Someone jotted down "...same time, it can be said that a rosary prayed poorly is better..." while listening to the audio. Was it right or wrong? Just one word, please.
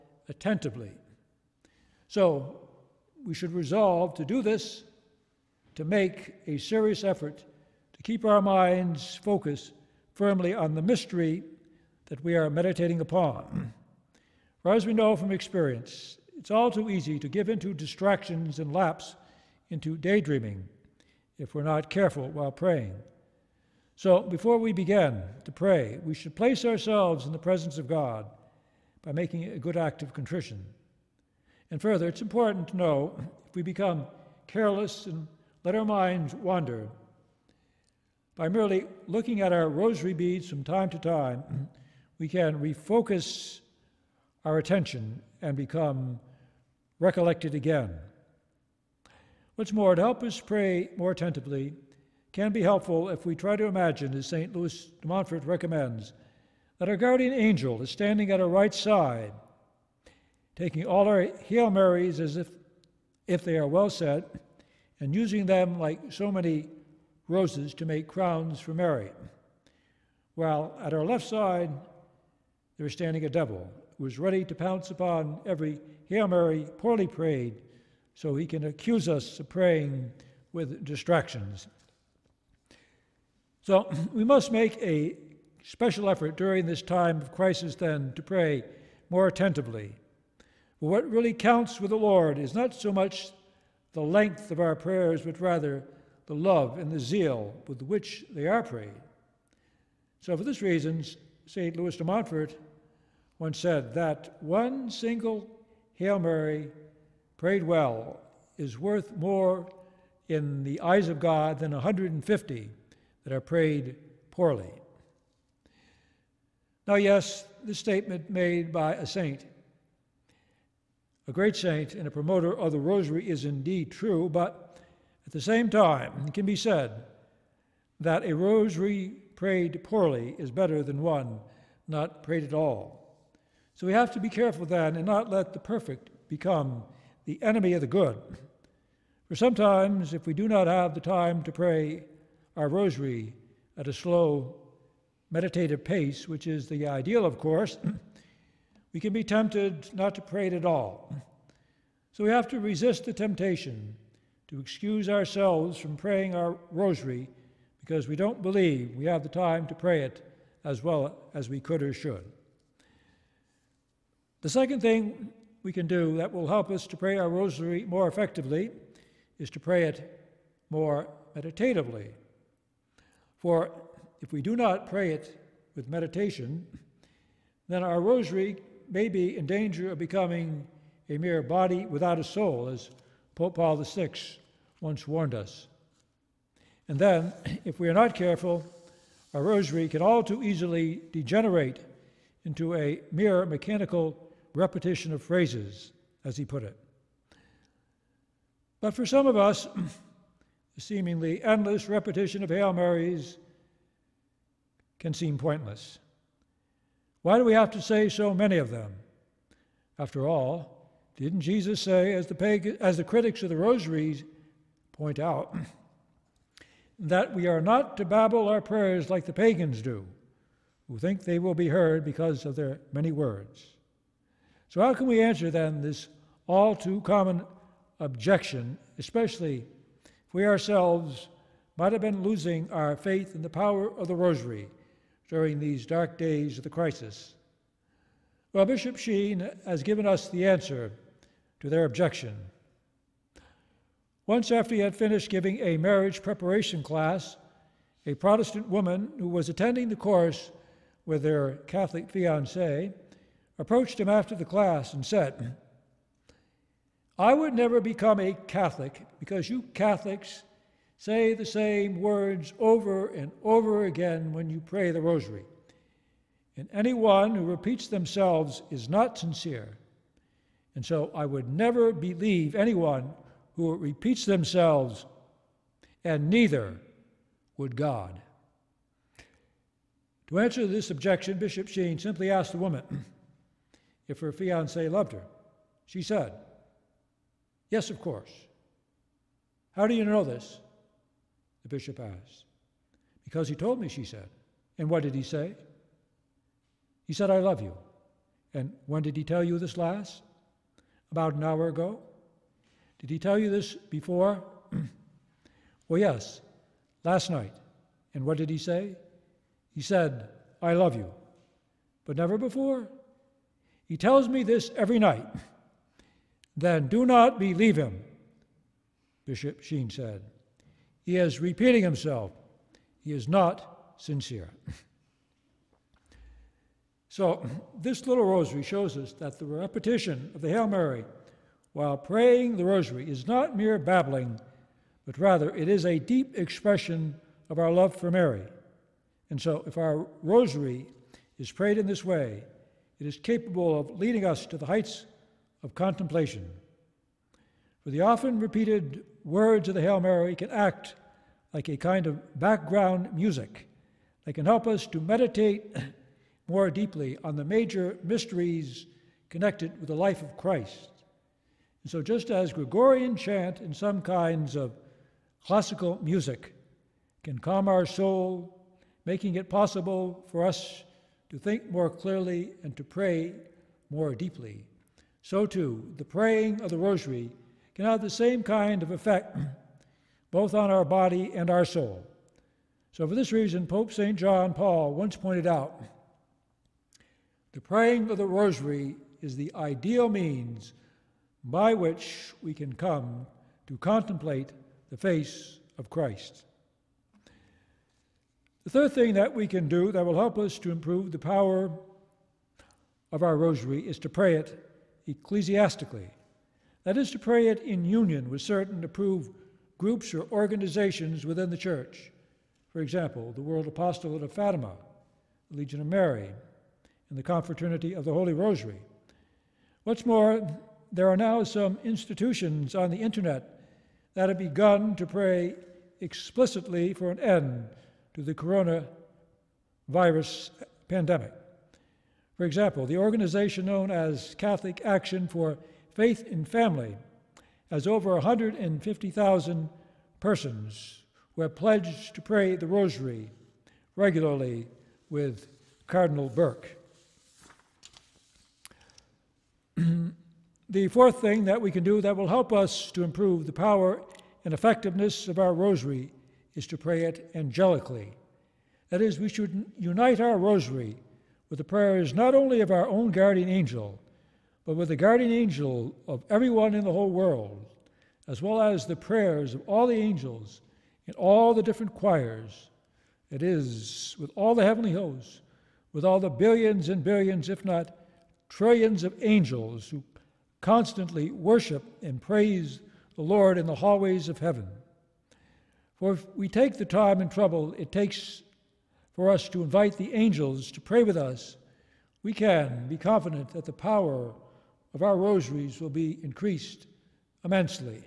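right.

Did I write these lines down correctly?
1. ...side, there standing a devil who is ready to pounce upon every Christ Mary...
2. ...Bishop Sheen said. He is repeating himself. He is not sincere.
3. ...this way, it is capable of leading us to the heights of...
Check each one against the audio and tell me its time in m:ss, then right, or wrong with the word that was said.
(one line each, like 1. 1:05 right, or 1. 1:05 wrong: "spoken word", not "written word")
1. 1:11 wrong: "Hail", not "Christ"
2. 5:19 right
3. 5:41 right.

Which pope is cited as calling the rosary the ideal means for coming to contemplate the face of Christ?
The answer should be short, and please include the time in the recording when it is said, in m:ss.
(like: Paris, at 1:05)
Pope St. John Paul, at 6:23.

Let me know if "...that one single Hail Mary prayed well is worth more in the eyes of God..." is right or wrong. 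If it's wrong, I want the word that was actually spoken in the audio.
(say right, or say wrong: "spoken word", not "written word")
right.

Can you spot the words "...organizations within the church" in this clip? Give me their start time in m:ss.
6:50.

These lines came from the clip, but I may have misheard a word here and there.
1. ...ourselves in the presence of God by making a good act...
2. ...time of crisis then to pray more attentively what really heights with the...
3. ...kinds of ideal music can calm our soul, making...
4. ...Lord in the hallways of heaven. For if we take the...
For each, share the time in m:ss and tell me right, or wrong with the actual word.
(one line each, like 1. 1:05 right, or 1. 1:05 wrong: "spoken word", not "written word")
1. 0:26 right
2. 1:26 wrong: "counts", not "heights"
3. 6:04 wrong: "classical", not "ideal"
4. 8:03 right.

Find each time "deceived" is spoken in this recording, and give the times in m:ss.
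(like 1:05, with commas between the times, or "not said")
not said.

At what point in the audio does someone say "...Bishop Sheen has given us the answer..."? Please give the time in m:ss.
3:58.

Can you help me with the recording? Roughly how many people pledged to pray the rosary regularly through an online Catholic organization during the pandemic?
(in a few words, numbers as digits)
150,000.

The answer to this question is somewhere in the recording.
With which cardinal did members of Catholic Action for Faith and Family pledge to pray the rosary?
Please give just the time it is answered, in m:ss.
7:25.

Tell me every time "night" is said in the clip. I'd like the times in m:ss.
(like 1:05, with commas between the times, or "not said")
5:07, 5:14.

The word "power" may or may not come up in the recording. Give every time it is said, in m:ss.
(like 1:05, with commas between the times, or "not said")
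3:53, 6:41, 7:33, 8:13.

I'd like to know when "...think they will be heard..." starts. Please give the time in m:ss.
3:40.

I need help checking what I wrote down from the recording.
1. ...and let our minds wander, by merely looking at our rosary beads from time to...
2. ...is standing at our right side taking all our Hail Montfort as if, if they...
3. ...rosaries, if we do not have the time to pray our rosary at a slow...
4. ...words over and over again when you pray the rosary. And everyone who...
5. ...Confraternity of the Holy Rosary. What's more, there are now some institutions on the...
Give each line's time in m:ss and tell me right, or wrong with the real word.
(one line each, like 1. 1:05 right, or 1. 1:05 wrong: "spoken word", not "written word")
1. 0:35 right
2. 0:57 wrong: "Marys", not "Montfort"
3. 2:19 wrong: "sometimes", not "rosaries"
4. 4:21 wrong: "anyone", not "everyone"
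5. 6:57 right.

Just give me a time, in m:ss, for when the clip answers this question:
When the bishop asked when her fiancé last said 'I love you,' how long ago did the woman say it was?
5:01.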